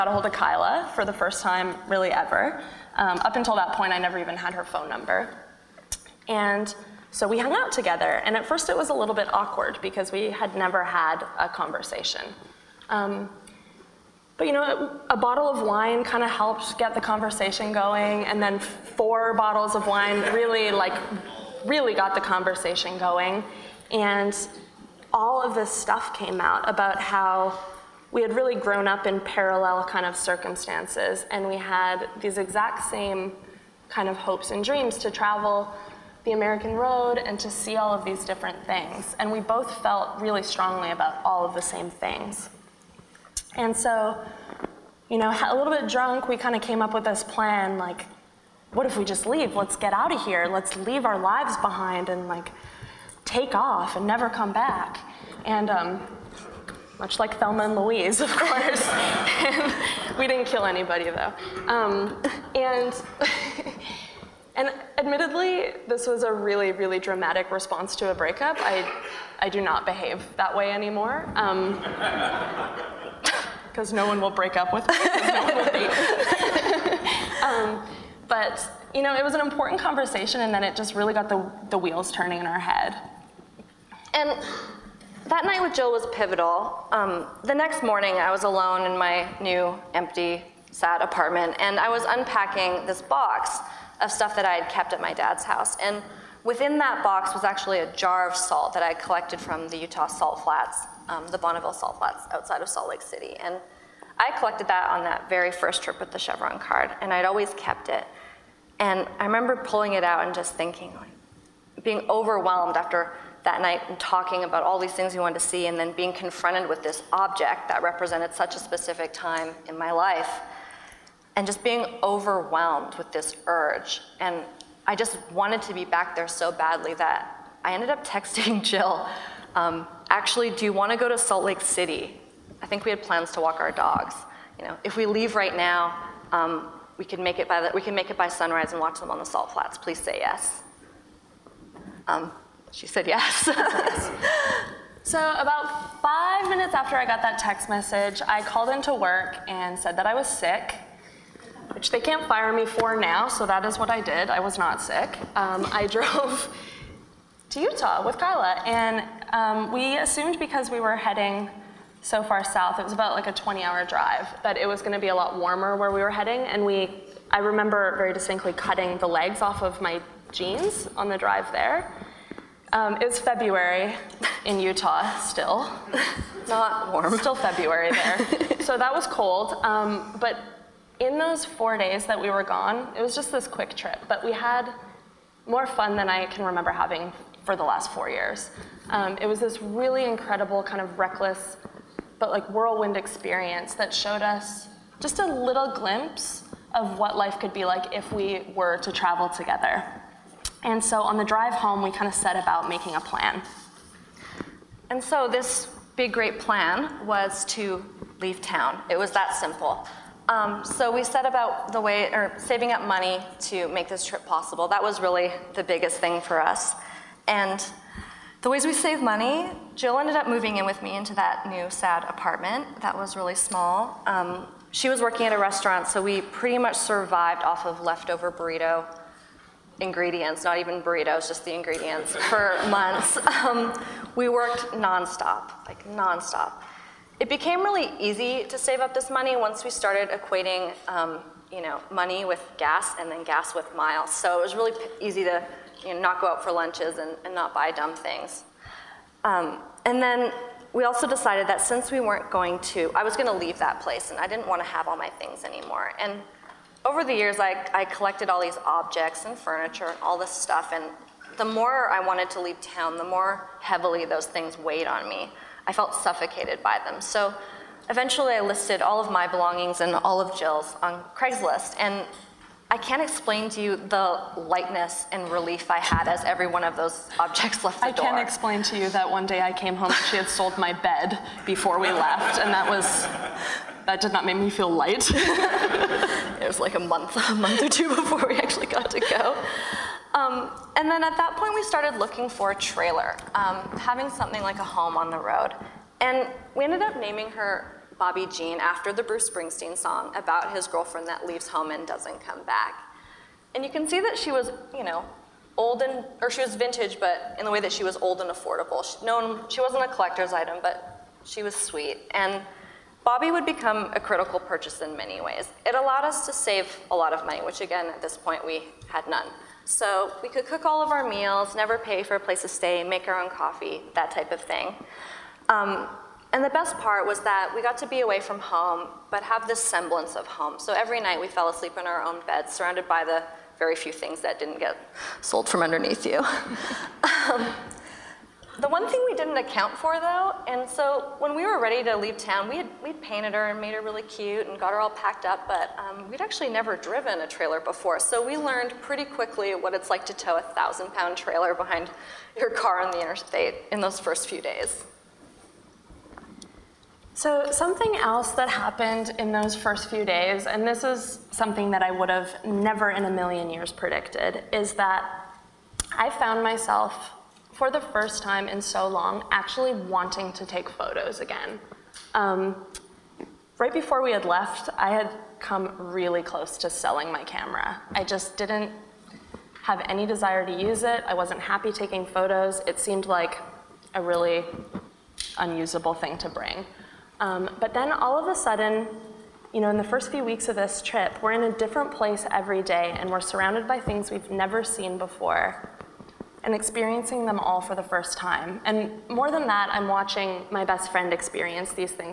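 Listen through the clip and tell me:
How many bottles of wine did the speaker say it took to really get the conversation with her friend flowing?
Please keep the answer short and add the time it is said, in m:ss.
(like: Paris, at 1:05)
4, at 0:18.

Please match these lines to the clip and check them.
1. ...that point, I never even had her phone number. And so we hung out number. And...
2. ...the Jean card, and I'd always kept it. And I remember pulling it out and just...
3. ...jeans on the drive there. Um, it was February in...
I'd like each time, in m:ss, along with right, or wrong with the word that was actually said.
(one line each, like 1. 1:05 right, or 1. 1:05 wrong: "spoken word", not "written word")
1. 0:03 wrong: "together", not "number"
2. 1:46 wrong: "Chevron", not "Jean"
3. 2:50 right.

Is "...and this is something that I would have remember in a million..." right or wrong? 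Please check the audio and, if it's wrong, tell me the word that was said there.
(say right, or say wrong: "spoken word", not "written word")
wrong: "never", not "remember".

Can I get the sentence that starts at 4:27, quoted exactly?
So eventually I listed all of my belongings and all of Jill's on Craigslist.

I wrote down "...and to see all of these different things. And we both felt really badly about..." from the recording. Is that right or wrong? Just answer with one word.
wrong.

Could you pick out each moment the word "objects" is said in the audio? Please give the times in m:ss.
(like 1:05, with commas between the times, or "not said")
1:57, 4:18, 4:37.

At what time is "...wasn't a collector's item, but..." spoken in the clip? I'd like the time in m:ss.
5:09.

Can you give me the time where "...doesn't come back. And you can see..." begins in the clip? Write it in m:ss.
5:01.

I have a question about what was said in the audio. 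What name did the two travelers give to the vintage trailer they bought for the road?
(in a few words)
Bobby Jean.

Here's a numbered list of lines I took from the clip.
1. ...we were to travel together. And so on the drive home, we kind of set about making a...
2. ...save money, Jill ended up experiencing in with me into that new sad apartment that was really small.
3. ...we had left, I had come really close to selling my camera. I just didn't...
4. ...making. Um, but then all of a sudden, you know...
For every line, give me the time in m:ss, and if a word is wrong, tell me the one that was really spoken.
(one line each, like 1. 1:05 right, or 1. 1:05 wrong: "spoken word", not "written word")
1. 3:18 right
2. 3:38 wrong: "moving", not "experiencing"
3. 6:14 right
4. 6:26 wrong: "bring", not "making".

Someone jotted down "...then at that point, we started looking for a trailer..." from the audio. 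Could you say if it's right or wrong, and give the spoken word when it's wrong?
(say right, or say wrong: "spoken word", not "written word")
right.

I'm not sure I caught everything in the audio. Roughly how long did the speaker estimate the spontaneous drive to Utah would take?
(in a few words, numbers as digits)
20 hours.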